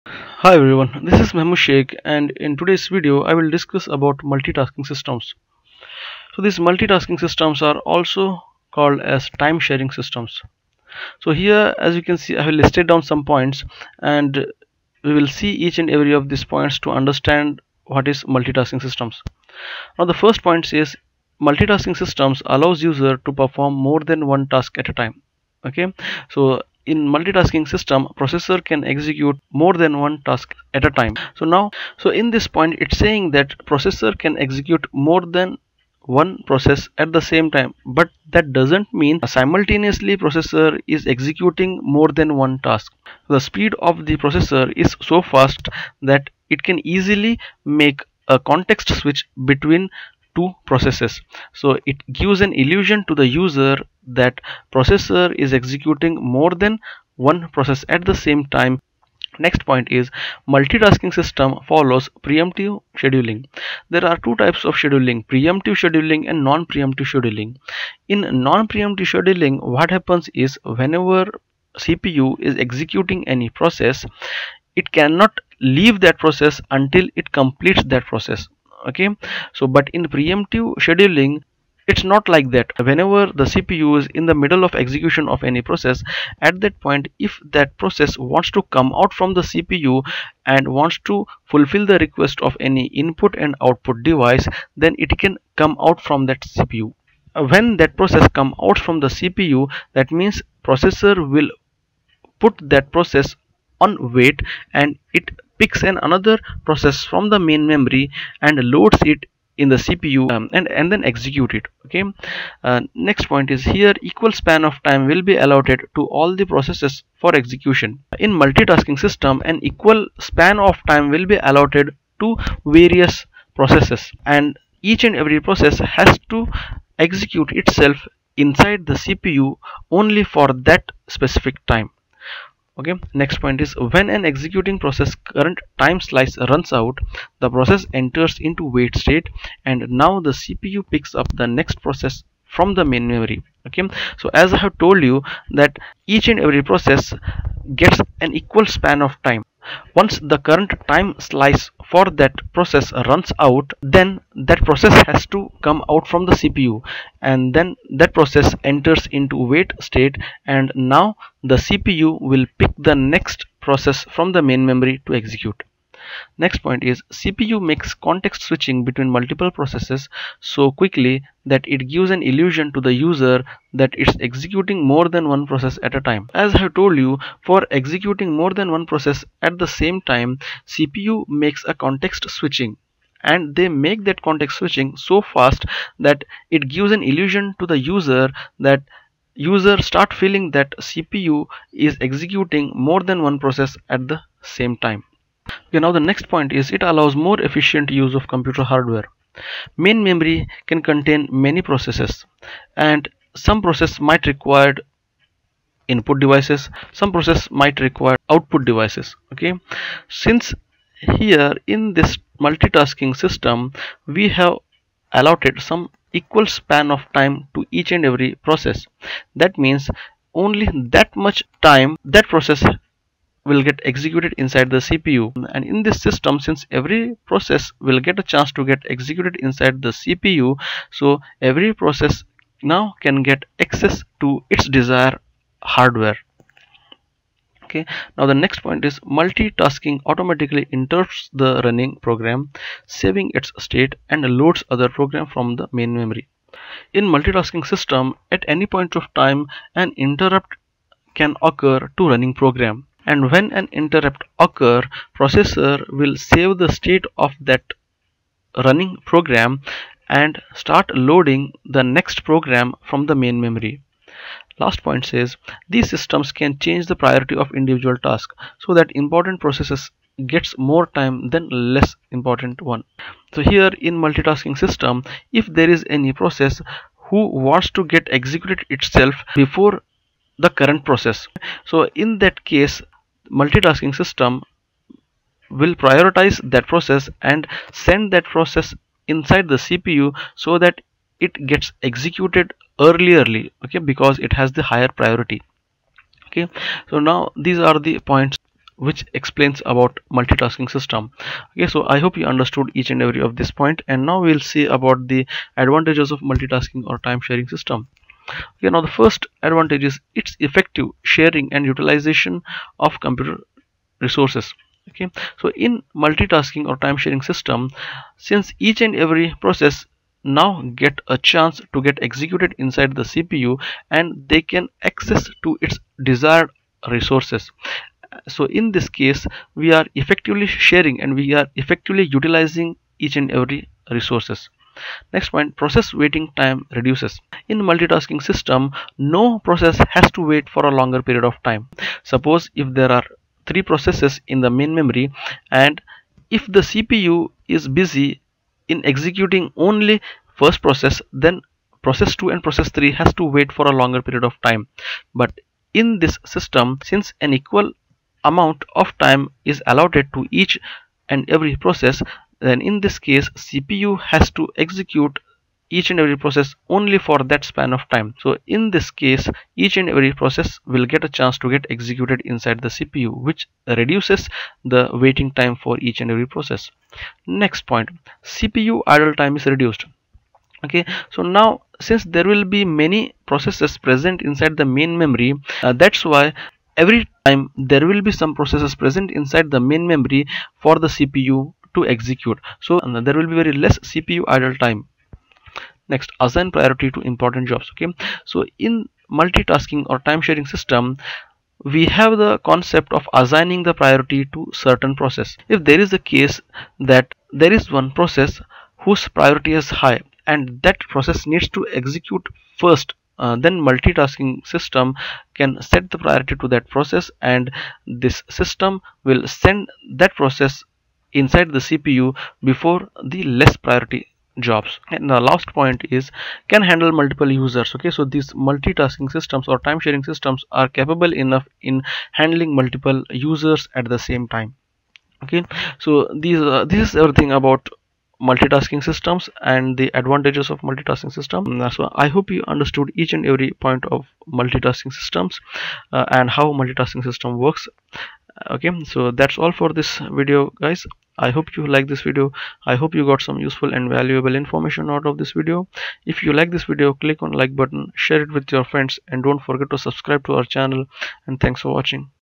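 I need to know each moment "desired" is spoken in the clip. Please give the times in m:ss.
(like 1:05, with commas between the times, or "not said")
3:54, 5:26.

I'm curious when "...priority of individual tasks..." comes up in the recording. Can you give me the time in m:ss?
4:26.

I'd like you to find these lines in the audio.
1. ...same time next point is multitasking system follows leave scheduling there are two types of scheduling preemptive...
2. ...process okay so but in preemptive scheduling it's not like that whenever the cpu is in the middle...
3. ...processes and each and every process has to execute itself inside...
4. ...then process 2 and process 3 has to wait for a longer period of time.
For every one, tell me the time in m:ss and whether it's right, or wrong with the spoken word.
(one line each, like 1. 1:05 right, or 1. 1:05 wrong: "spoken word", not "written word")
1. 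0:58 wrong: "preemptive", not "leave"
2. 1:18 right
3. 2:03 right
4. 5:51 right.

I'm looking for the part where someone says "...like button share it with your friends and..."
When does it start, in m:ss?
7:37.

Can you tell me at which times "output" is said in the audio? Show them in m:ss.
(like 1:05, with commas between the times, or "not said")
1:33, 3:28.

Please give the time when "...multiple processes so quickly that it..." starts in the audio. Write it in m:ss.
2:49.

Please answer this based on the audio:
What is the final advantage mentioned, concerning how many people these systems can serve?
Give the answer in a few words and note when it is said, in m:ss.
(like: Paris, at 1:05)
can handle multiple users, at 7:06.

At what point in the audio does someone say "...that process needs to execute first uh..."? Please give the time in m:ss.
6:50.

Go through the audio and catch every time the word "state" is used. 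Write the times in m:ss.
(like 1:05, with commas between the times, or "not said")
2:18, 2:39, 4:03, 4:16.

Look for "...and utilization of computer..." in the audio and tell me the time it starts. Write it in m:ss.
5:11.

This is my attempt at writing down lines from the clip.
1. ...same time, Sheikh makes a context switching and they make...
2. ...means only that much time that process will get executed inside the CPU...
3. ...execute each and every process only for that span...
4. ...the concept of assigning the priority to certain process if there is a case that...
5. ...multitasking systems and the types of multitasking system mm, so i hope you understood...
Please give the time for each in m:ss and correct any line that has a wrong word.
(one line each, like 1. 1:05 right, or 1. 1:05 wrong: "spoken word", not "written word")
1. 2:59 wrong: "CPU", not "Sheikh"
2. 3:39 right
3. 6:04 right
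4. 6:42 right
5. 7:18 wrong: "advantages", not "types".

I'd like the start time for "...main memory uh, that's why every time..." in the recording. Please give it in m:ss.
6:24.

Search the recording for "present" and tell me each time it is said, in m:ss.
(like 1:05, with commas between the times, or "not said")
6:23, 6:28.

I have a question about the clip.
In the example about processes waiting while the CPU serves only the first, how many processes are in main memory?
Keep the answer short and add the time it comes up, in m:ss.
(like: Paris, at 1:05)
3, at 5:43.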